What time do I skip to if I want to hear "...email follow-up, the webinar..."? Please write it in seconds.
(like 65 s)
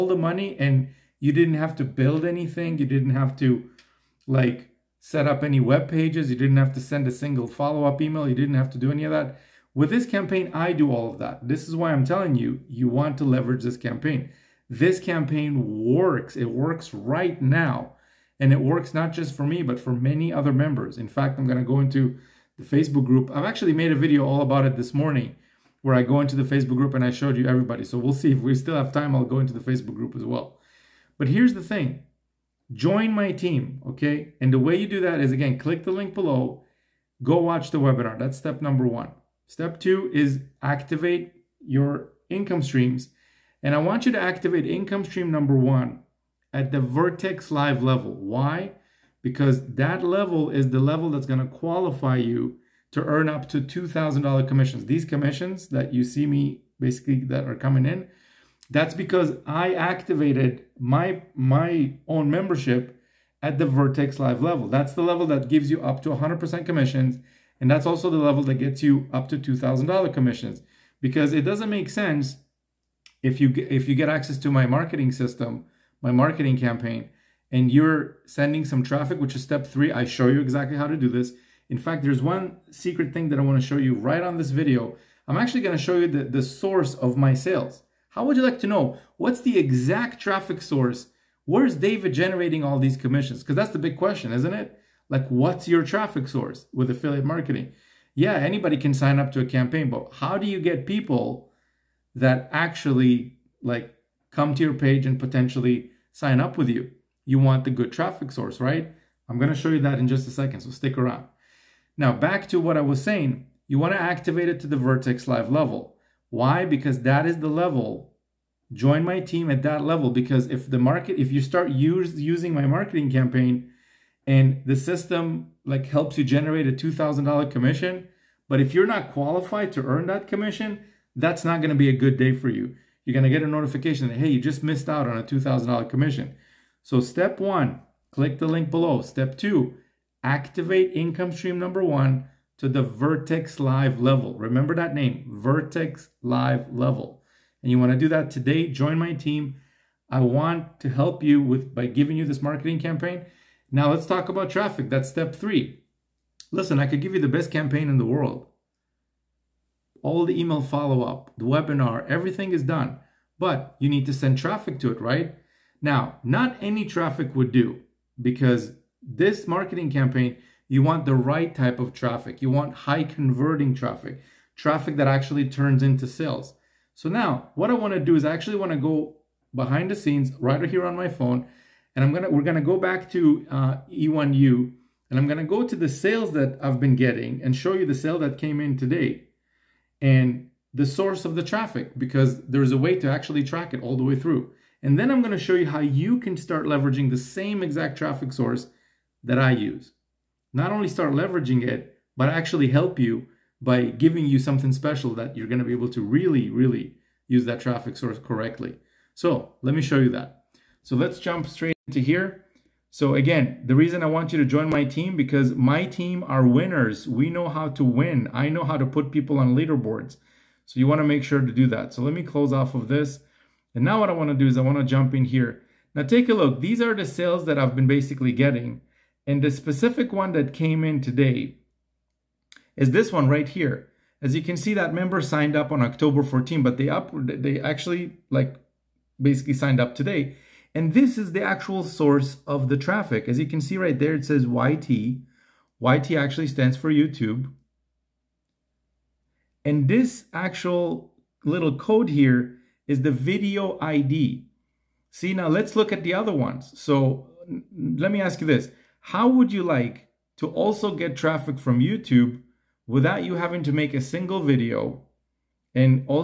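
160 s.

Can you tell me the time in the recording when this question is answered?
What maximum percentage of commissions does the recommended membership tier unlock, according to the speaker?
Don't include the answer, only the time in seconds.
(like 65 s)
66 s.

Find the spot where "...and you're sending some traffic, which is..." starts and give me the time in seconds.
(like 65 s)
77 s.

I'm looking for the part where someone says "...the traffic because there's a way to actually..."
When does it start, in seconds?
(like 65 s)
191 s.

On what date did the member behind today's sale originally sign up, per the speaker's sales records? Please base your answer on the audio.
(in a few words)
October 14.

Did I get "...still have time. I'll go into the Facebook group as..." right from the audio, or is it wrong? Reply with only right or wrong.
right.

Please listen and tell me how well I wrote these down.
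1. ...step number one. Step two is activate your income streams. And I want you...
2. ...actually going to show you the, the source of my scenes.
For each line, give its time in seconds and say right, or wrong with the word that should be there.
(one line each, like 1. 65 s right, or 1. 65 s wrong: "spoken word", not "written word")
1. 38 s right
2. 85 s wrong: "sales", not "scenes".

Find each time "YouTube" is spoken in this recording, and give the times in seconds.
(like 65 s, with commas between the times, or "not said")
246 s, 261 s.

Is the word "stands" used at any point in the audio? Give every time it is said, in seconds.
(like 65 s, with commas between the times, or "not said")
246 s.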